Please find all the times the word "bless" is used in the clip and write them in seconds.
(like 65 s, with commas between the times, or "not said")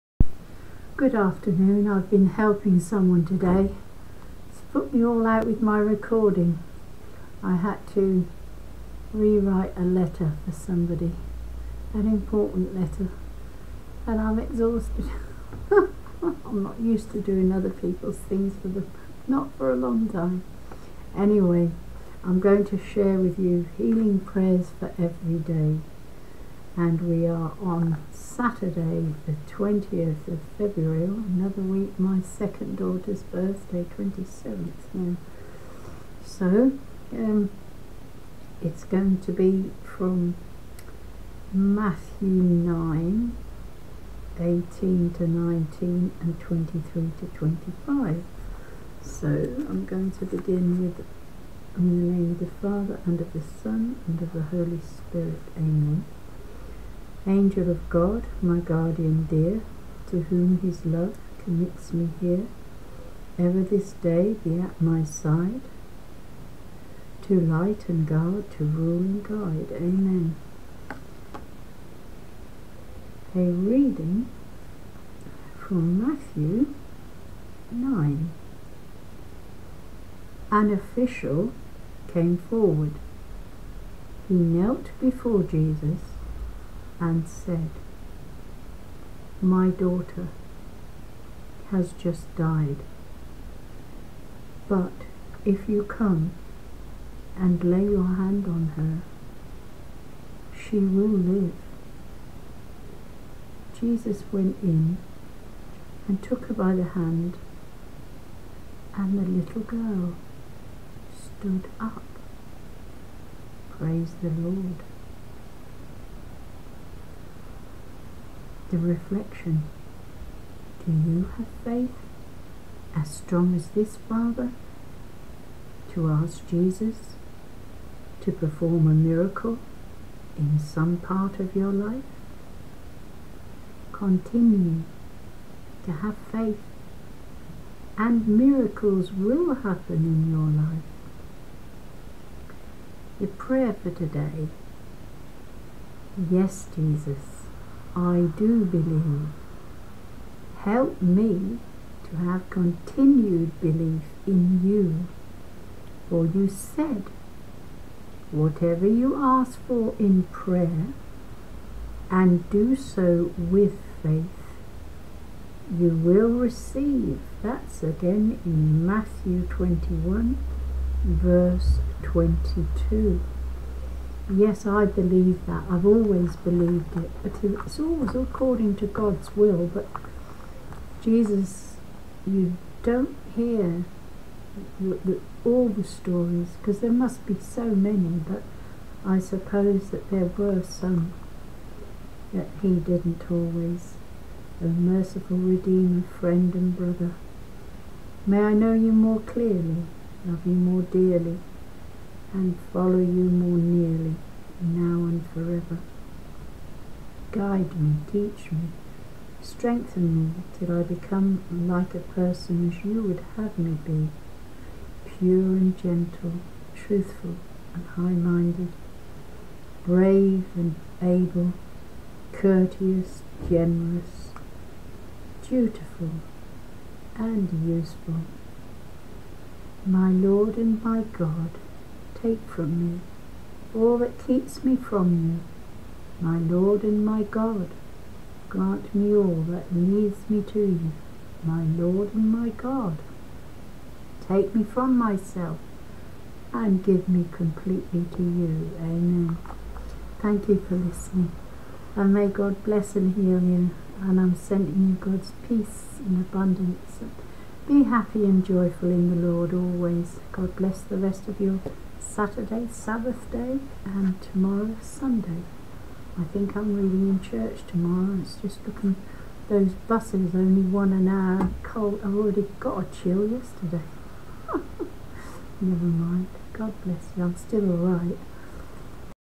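252 s, 260 s, 276 s.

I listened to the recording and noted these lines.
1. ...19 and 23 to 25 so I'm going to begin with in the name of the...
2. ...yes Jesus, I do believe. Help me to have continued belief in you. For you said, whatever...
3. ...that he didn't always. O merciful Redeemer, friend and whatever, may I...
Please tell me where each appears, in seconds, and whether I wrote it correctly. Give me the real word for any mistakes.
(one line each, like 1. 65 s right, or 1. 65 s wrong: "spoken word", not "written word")
1. 45 s right
2. 146 s right
3. 192 s wrong: "brother", not "whatever".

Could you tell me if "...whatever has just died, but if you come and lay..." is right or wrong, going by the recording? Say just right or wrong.
wrong.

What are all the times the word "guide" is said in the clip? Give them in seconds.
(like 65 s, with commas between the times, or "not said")
69 s, 207 s.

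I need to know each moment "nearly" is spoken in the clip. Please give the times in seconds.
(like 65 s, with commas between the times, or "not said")
203 s.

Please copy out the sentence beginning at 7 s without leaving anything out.
I had to rewrite a letter for somebody, an important letter, and I'm exhausted.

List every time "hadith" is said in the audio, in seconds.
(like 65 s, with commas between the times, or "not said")
not said.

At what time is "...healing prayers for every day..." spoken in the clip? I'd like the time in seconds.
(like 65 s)
23 s.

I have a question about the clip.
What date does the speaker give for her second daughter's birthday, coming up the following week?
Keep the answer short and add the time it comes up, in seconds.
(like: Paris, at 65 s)
27th, at 33 s.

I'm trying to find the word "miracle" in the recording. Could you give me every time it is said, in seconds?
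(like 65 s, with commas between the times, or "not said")
128 s, 138 s.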